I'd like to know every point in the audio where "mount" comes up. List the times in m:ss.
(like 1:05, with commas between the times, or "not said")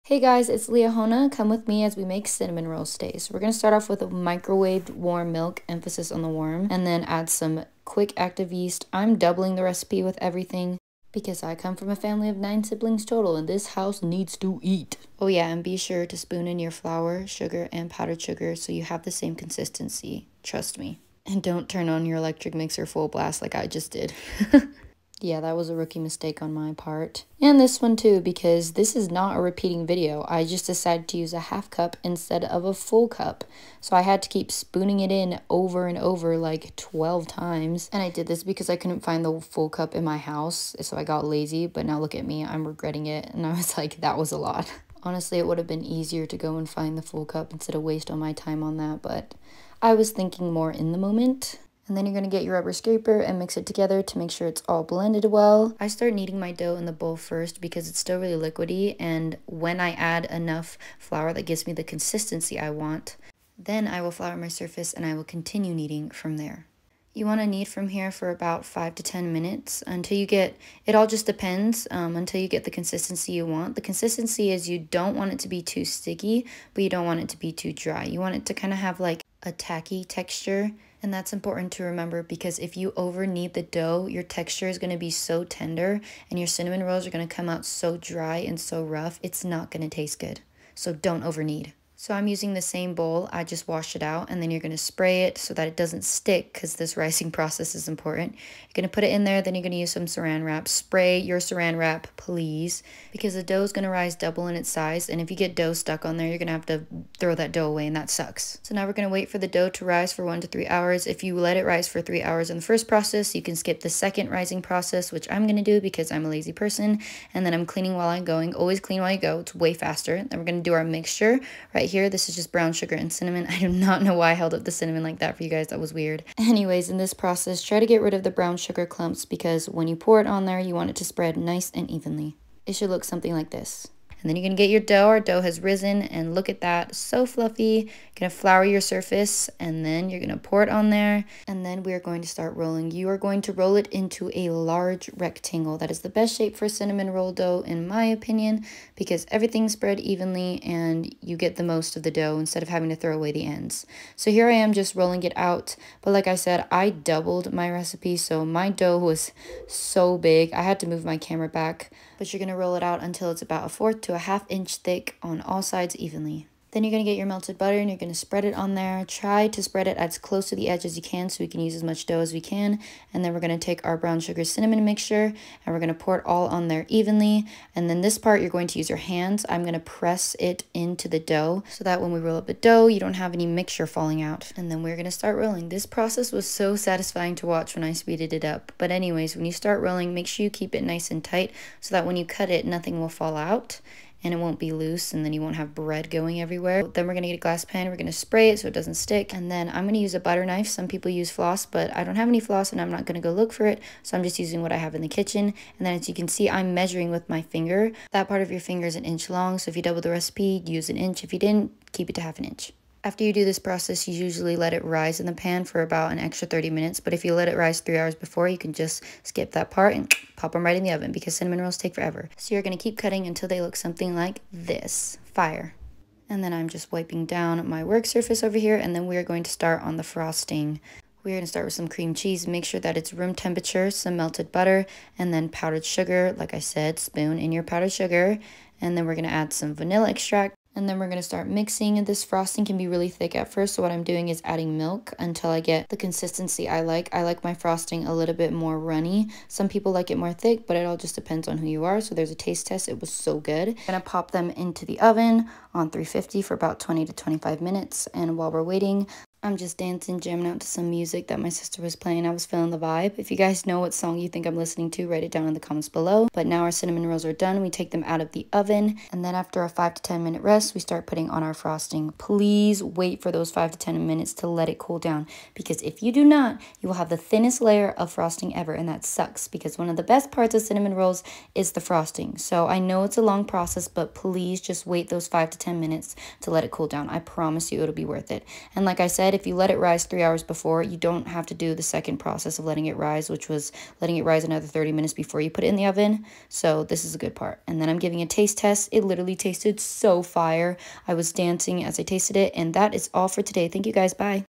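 not said.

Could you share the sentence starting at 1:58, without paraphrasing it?
Always clean while you go, it's way faster.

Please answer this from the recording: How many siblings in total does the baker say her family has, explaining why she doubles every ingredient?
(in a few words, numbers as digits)
9.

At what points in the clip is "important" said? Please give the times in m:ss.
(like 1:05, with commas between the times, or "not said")
1:21, 1:37.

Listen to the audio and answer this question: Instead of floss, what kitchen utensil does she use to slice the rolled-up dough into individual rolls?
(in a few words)
Butter knife.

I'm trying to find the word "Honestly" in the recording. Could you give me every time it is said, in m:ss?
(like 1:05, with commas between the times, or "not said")
0:45.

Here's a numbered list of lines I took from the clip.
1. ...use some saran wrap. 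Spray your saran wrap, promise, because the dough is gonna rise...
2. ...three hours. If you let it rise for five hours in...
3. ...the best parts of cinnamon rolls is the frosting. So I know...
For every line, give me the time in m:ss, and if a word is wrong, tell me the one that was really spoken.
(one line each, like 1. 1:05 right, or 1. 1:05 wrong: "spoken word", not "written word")
1. 1:39 wrong: "please", not "promise"
2. 1:50 wrong: "three", not "five"
3. 4:39 right.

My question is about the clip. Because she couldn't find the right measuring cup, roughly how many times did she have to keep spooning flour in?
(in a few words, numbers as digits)
12.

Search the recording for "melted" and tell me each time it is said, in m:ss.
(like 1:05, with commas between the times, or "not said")
2:47, 3:54.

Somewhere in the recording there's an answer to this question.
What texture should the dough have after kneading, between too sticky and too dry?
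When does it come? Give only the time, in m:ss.
1:19.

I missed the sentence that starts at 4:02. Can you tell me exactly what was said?
This frosting can be really thick at first, so what I'm doing is adding milk until I get the consistency I like.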